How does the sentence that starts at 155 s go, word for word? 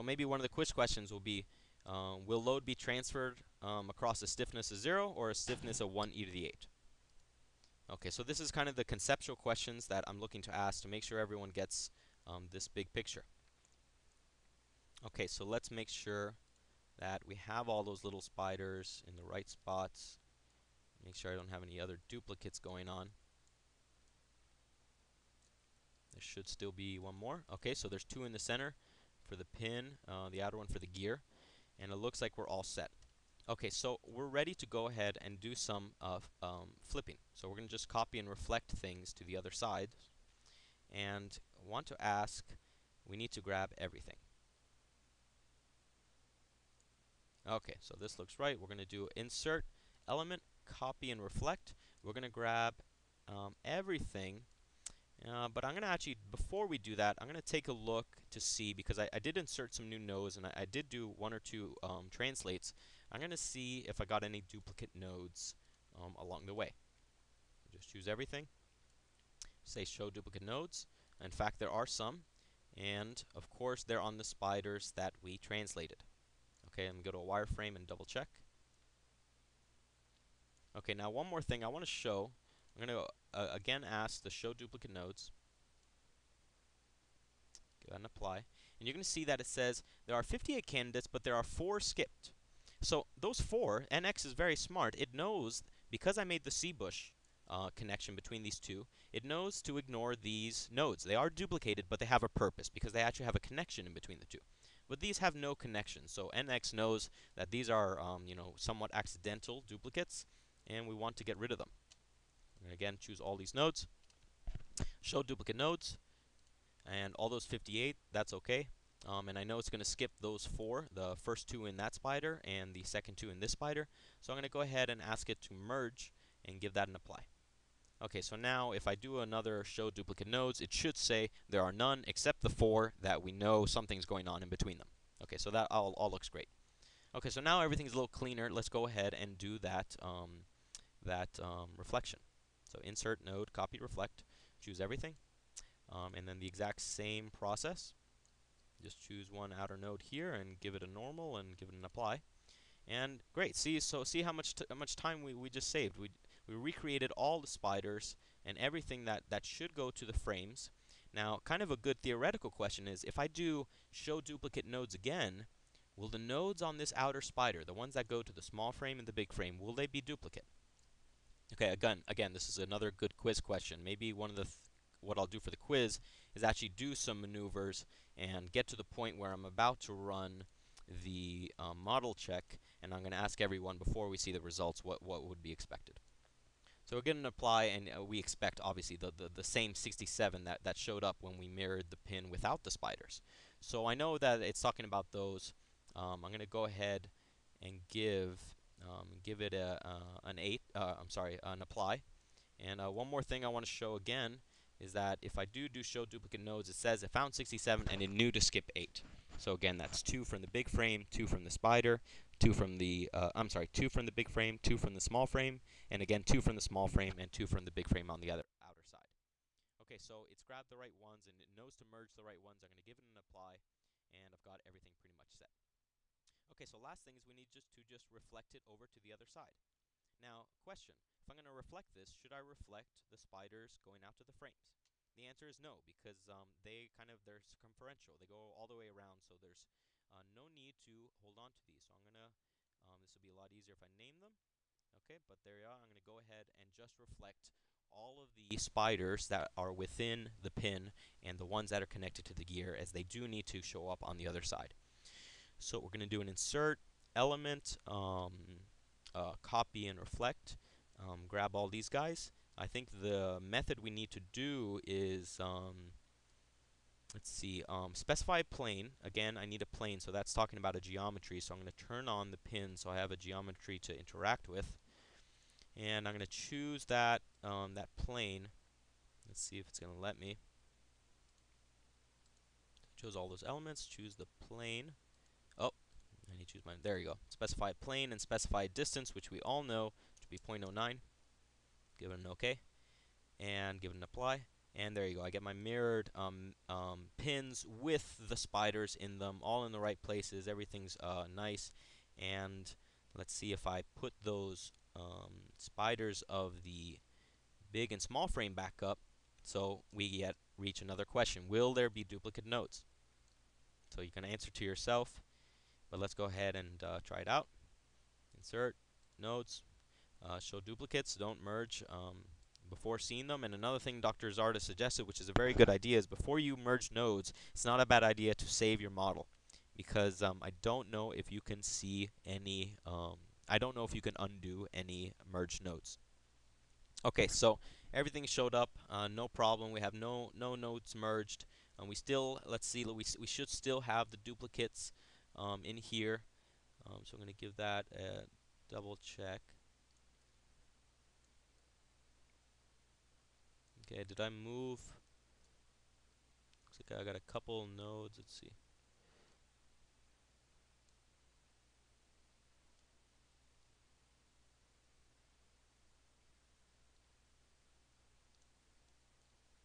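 We we recreated all the spiders and everything that that should go to the frames.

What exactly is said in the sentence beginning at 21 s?
Make sure I don't have any other duplicates going on.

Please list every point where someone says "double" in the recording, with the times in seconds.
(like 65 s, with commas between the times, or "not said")
77 s, 348 s.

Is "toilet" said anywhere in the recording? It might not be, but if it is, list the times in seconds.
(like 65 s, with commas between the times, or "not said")
not said.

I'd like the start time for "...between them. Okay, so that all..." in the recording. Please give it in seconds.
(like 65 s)
134 s.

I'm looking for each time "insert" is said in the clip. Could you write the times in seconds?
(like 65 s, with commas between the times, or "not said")
49 s, 59 s, 142 s, 256 s, 318 s.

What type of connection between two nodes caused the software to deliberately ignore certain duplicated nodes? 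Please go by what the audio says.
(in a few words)
C bush.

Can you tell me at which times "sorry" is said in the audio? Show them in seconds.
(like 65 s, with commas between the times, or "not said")
201 s, 213 s.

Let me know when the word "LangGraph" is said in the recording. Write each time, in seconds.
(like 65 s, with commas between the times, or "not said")
not said.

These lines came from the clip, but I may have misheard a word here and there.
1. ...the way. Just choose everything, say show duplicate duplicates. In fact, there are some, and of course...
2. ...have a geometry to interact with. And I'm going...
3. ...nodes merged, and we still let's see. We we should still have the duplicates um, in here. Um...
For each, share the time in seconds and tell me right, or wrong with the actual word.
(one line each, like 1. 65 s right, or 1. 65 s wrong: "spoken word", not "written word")
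1. 66 s wrong: "nodes", not "duplicates"
2. 272 s right
3. 340 s right.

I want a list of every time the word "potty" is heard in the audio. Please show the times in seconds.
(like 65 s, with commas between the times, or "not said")
not said.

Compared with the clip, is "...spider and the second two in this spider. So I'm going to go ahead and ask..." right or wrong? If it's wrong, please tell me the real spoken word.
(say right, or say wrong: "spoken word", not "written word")
right.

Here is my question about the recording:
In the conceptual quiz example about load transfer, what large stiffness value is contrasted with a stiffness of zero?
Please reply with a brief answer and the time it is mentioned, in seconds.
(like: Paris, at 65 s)
1e8, at 5 s.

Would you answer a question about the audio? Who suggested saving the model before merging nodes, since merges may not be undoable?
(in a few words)
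Dr. Zarda.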